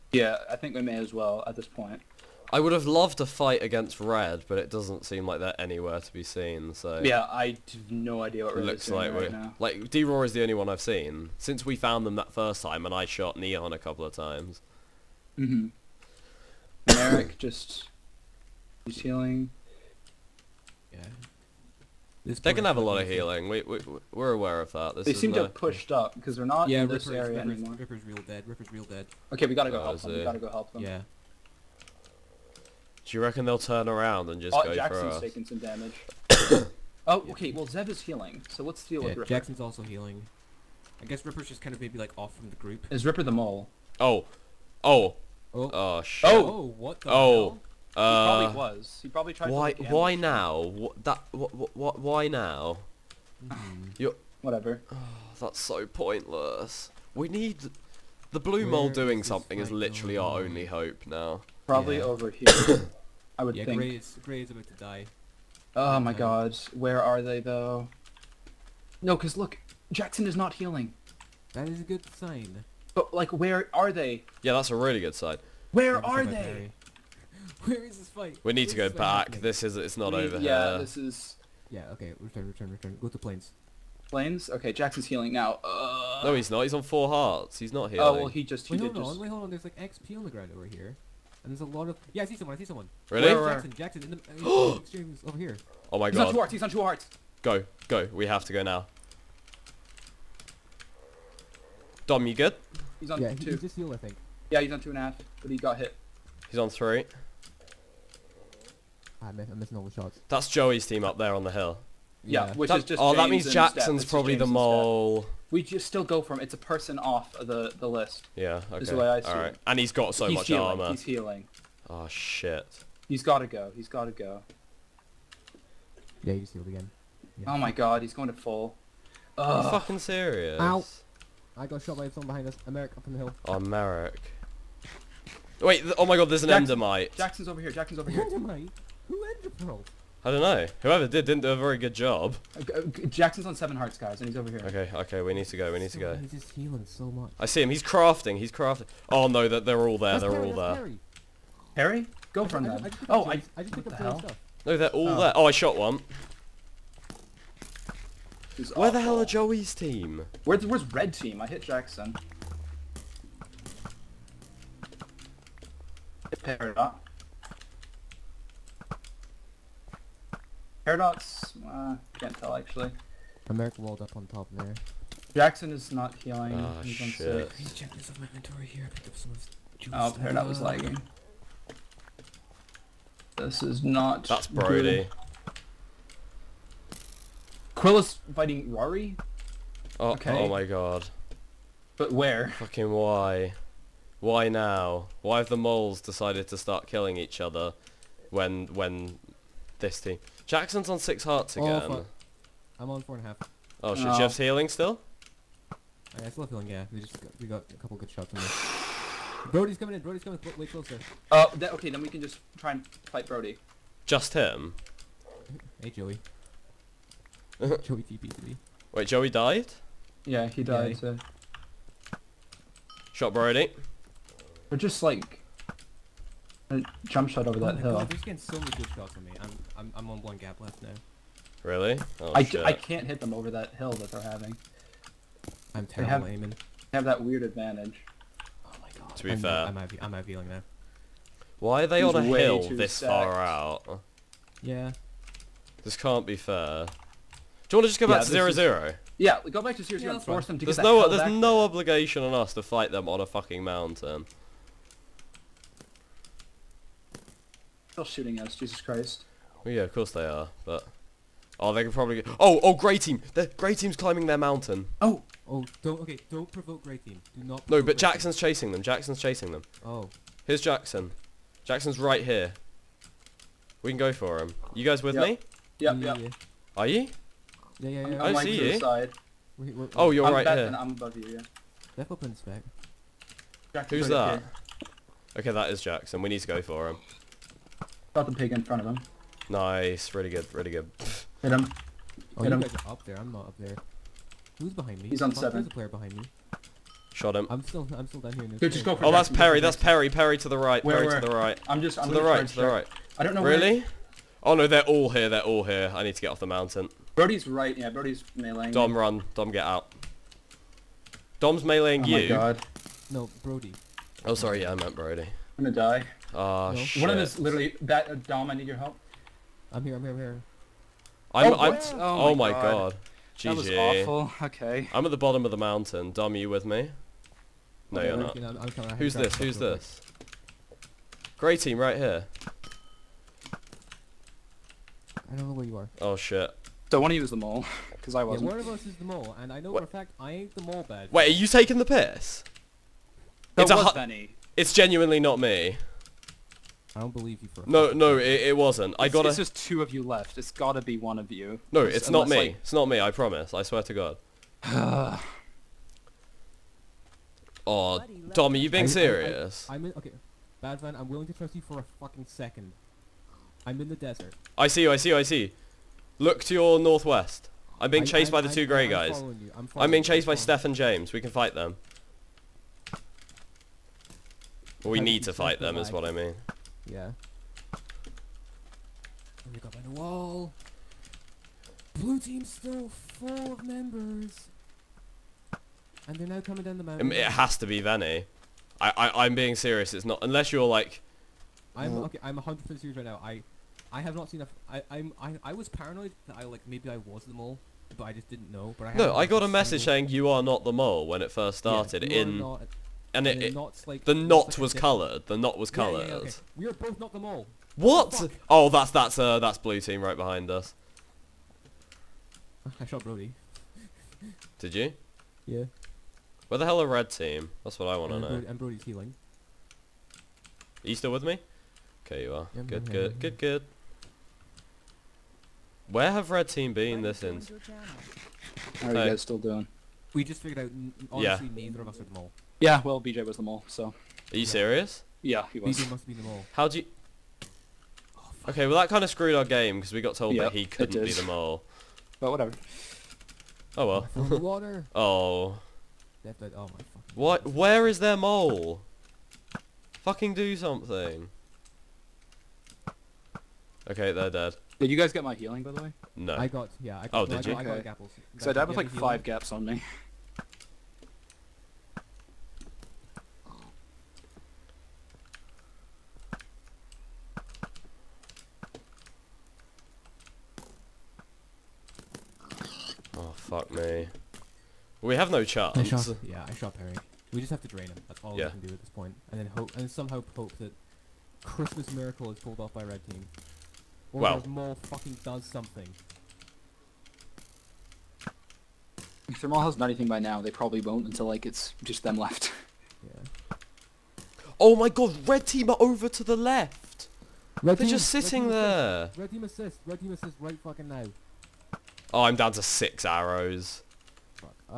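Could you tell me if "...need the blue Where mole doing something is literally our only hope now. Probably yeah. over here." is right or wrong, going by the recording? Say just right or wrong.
right.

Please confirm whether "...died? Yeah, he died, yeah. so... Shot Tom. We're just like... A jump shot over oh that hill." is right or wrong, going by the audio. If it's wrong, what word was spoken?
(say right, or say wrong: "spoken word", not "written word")
wrong: "Brody", not "Tom".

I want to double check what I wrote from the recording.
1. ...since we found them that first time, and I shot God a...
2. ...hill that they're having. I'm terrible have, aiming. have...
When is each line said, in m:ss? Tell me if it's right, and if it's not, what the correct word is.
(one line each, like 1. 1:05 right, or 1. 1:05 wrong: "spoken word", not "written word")
1. 0:11 wrong: "Neon", not "God"
2. 3:53 right.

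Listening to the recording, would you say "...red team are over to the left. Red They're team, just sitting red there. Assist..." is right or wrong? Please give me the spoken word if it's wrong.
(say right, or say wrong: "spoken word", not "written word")
right.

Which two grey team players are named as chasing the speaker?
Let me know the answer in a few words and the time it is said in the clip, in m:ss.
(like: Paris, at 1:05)
Steph and James, at 6:10.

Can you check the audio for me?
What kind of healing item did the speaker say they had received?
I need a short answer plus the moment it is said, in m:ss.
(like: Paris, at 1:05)
Apples, at 7:37.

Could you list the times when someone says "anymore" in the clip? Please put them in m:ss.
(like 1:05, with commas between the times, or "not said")
0:27.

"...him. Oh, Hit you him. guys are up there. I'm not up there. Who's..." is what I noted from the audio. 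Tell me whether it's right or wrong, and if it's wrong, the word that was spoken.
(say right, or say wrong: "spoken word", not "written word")
right.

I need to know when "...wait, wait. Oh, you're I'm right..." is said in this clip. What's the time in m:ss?
4:39.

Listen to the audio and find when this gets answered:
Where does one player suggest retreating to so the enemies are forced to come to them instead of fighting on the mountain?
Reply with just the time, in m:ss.
4:09.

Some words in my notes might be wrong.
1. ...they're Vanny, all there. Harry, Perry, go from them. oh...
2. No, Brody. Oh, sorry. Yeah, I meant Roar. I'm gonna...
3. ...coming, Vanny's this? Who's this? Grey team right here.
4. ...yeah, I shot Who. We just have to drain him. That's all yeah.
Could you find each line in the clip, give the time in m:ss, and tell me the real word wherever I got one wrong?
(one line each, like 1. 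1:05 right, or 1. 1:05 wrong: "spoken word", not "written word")
1. 2:30 wrong: "Perry", not "Vanny"
2. 5:13 wrong: "Brody", not "Roar"
3. 5:28 wrong: "Who", not "Vanny"
4. 7:56 wrong: "Perry", not "Who".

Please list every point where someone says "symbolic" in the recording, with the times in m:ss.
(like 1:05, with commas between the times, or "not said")
not said.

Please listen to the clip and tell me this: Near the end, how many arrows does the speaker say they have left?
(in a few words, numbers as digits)
6.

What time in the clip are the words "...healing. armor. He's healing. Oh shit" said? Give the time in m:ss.
2:00.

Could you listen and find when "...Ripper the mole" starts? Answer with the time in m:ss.
0:43.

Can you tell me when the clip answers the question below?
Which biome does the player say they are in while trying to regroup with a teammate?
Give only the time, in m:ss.
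6:03.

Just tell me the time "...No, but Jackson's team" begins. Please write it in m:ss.
4:27.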